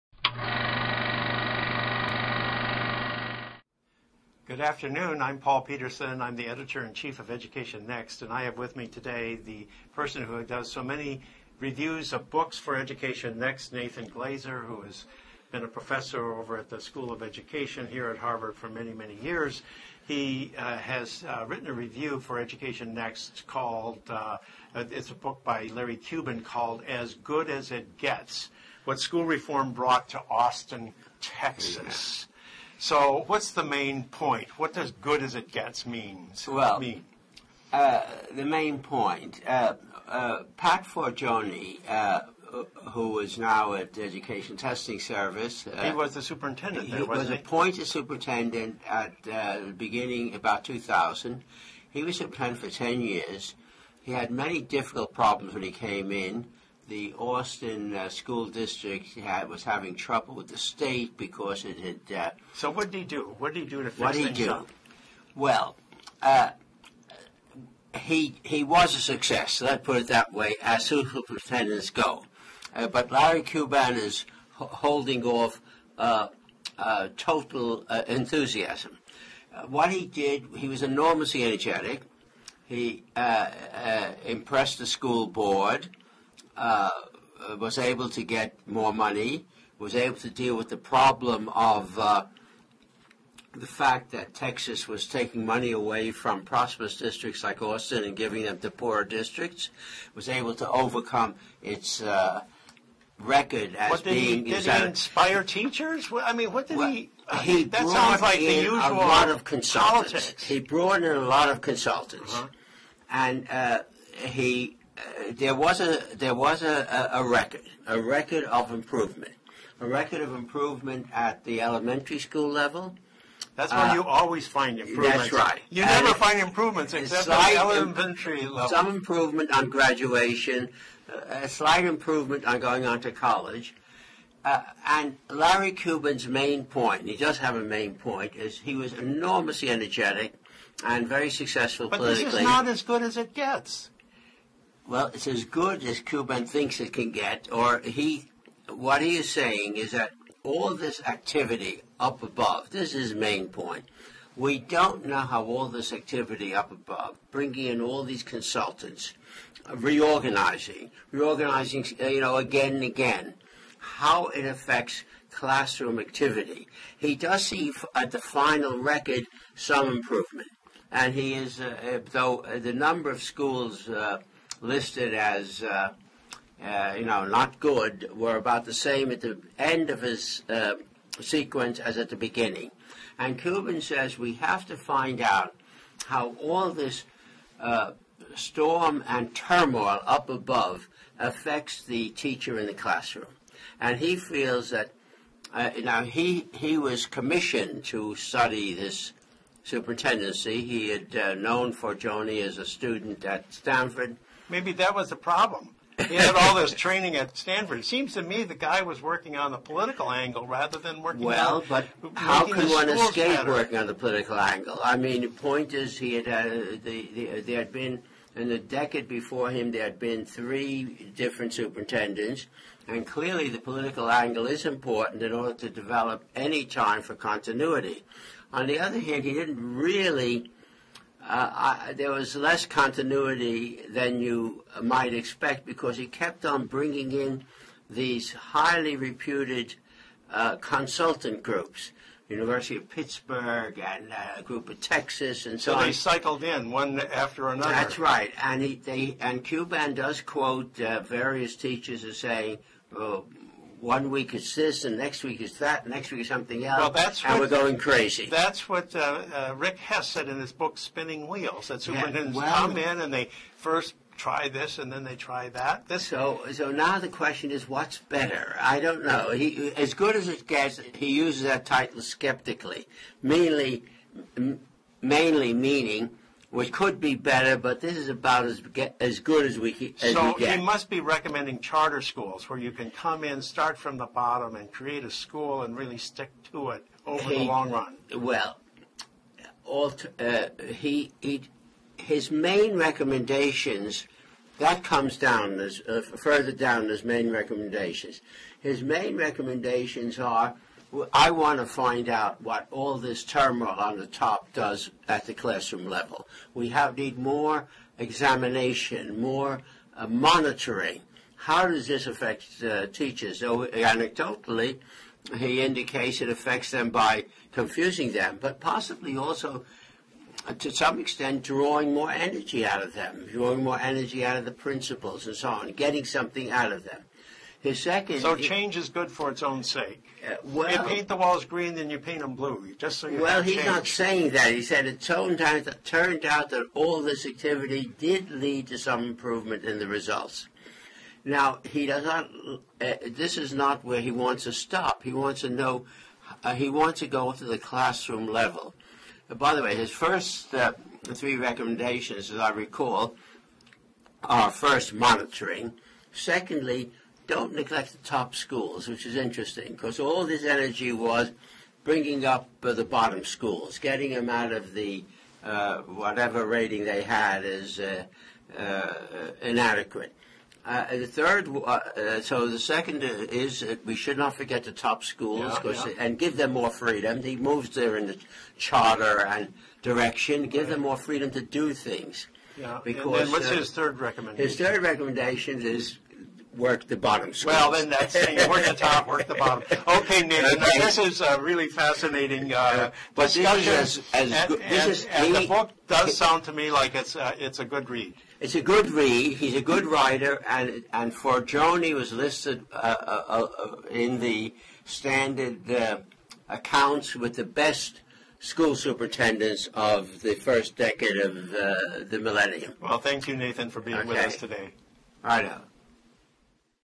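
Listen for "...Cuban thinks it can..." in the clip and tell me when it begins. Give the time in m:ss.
2:25.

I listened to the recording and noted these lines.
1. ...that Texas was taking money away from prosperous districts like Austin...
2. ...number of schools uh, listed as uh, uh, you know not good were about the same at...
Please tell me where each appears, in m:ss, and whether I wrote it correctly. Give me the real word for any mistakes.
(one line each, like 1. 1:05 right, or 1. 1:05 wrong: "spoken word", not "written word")
1. 1:34 right
2. 2:52 right.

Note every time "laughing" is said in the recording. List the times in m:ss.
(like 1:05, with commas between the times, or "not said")
not said.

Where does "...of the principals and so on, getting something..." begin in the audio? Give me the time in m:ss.
5:24.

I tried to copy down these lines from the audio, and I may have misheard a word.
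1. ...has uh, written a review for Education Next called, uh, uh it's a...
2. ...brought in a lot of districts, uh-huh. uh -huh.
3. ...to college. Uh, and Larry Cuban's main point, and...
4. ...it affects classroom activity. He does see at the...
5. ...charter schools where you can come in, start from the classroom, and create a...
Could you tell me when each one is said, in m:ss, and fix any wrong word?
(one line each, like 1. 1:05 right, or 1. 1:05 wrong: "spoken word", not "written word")
1. 0:20 right
2. 1:50 wrong: "consultants", not "districts"
3. 2:13 right
4. 2:44 right
5. 4:41 wrong: "bottom", not "classroom".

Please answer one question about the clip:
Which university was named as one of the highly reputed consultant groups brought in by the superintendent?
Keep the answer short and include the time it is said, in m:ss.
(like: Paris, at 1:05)
University of Pittsburgh, at 4:02.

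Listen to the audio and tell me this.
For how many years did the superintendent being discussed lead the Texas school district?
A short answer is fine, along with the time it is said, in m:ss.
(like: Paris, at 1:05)
10, at 0:52.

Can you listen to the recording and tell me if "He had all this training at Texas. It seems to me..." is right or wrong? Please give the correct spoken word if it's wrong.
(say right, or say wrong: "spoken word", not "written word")
wrong: "Stanford", not "Texas".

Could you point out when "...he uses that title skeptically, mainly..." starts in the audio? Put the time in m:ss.
4:30.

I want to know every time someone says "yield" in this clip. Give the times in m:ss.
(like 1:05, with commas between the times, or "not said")
not said.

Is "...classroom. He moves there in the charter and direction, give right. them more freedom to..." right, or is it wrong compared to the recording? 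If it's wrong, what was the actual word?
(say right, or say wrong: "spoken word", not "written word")
wrong: "freedom", not "classroom".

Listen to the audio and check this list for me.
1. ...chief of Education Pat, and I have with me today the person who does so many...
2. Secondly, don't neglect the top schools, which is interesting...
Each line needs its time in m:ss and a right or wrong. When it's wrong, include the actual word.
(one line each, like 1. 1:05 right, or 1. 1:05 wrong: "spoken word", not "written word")
1. 0:06 wrong: "Next", not "Pat"
2. 5:56 right.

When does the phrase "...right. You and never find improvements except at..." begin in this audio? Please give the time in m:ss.
2:05.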